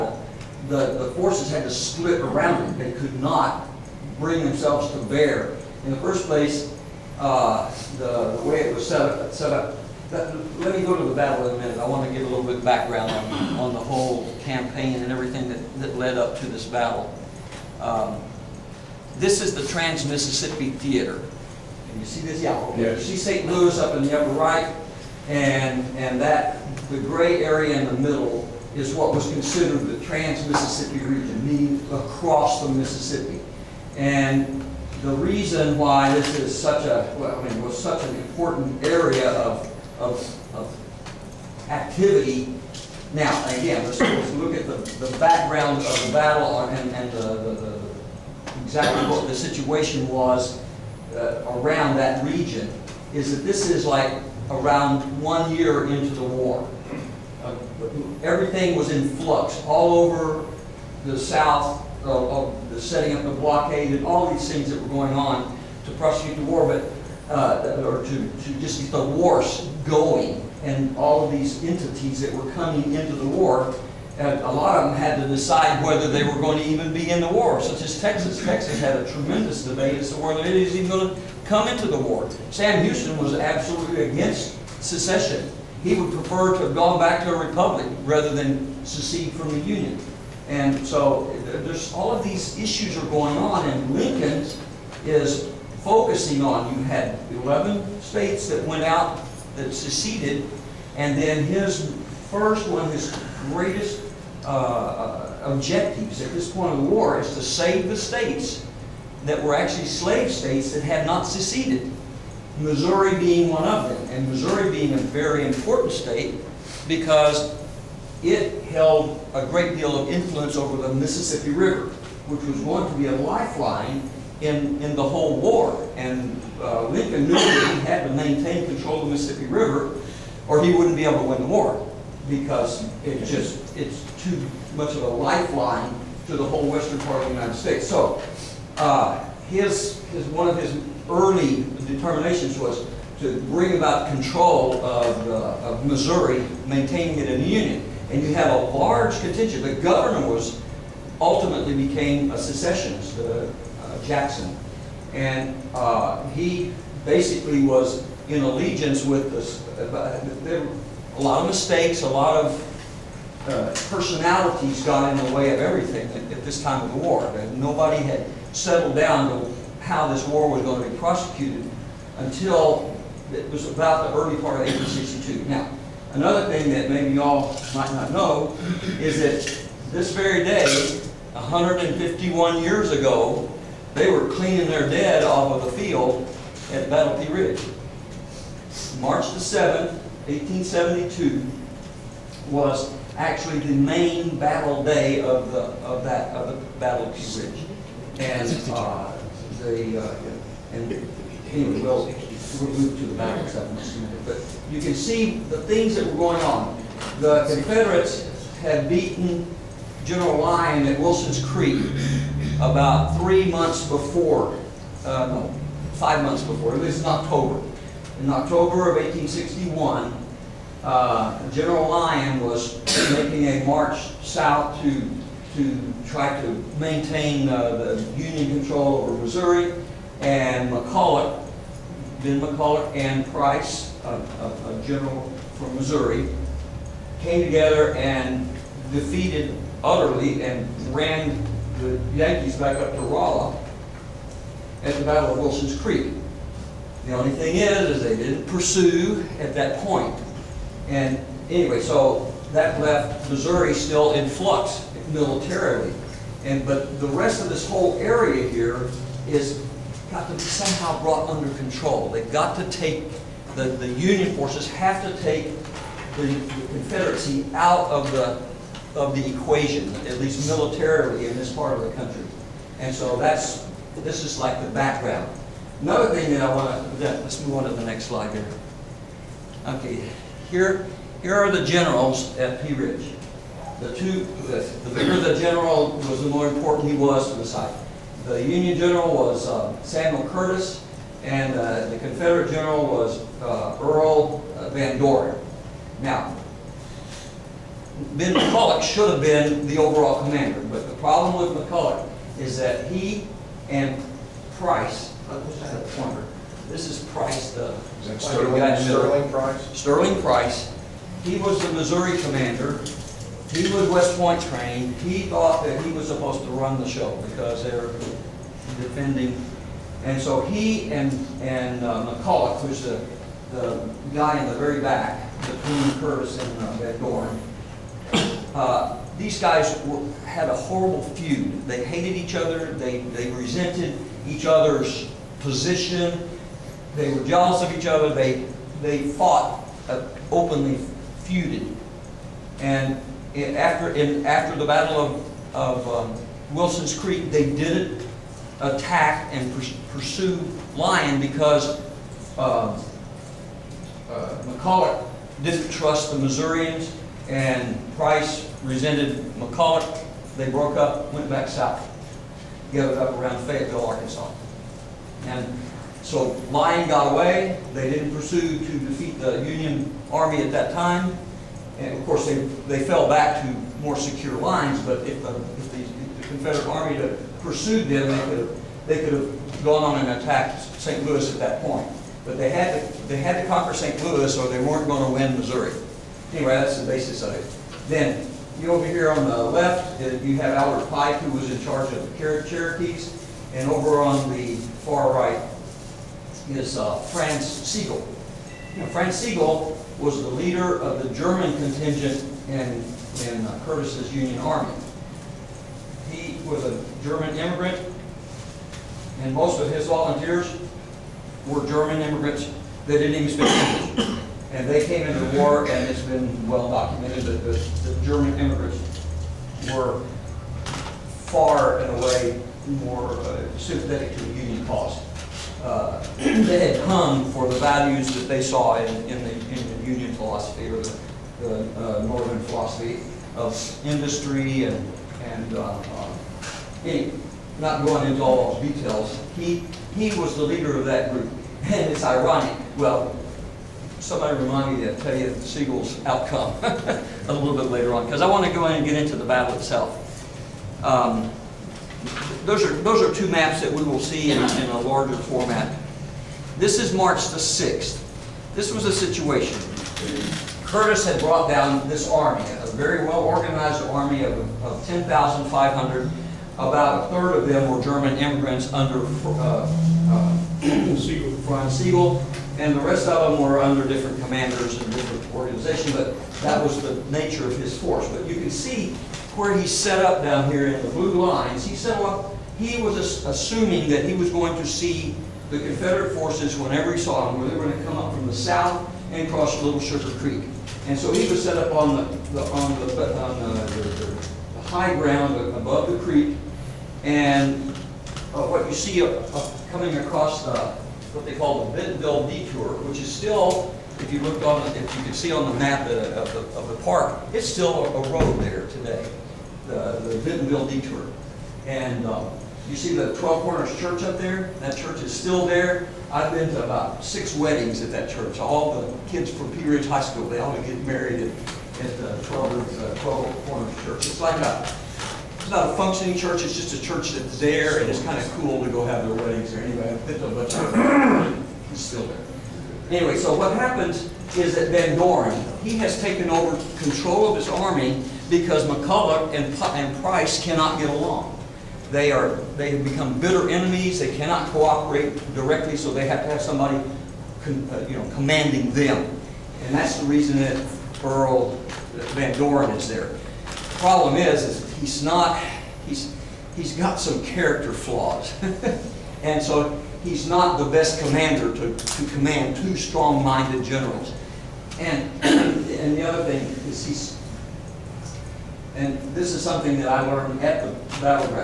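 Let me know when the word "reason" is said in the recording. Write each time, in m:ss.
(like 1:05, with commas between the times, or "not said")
0:35, 9:10.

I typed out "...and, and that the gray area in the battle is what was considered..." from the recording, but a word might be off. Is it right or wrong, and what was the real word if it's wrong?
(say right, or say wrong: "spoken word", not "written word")
wrong: "middle", not "battle".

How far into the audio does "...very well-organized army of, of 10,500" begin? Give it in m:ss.
7:42.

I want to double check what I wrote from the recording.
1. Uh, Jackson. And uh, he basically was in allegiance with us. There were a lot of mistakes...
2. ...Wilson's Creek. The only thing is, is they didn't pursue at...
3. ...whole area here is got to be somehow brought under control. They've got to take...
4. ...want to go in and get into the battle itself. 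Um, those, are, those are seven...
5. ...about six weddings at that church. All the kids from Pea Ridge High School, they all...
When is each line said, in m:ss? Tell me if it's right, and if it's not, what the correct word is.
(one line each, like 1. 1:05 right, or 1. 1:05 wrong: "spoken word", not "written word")
1. 2:33 right
2. 4:05 right
3. 4:17 right
4. 7:28 wrong: "two", not "seven"
5. 8:36 right.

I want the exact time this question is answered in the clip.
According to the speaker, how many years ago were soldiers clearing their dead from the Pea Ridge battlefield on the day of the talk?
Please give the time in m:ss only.
3:01.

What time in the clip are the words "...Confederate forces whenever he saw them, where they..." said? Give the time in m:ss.
8:05.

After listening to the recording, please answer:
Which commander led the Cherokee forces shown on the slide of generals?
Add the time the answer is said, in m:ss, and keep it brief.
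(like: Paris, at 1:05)
Albert Pike, at 6:30.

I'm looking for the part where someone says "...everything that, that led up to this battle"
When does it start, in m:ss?
0:15.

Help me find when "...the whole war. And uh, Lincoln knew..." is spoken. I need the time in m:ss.
2:04.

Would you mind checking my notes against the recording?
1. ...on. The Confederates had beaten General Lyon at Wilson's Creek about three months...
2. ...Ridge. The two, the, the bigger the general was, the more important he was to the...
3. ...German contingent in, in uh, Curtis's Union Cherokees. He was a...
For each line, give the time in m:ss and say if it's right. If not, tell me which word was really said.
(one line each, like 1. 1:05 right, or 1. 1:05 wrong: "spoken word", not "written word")
1. 3:26 right
2. 4:42 right
3. 6:41 wrong: "Army", not "Cherokees".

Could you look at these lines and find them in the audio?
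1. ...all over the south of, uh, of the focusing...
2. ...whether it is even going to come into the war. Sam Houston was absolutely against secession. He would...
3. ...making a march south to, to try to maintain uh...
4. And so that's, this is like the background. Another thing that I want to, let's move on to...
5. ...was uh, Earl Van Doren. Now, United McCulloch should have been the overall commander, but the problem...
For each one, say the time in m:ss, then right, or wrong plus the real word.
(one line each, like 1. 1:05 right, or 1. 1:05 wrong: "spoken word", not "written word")
1. 0:59 wrong: "setting", not "focusing"
2. 1:20 right
3. 3:43 right
4. 4:32 right
5. 4:52 wrong: "Ben", not "United".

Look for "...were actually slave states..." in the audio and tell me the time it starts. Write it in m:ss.
1:49.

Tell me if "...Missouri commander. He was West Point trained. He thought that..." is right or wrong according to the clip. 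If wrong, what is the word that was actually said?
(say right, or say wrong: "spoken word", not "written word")
right.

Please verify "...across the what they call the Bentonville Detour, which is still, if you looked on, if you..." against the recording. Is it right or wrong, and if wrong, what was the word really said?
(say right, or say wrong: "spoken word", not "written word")
right.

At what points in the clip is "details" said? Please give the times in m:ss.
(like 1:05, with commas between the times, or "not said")
7:18.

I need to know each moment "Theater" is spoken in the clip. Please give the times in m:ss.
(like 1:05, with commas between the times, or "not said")
0:20.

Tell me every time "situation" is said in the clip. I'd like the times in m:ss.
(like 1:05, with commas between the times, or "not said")
0:49, 7:38.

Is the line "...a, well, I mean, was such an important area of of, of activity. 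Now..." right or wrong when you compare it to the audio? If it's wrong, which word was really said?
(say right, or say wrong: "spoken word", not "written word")
right.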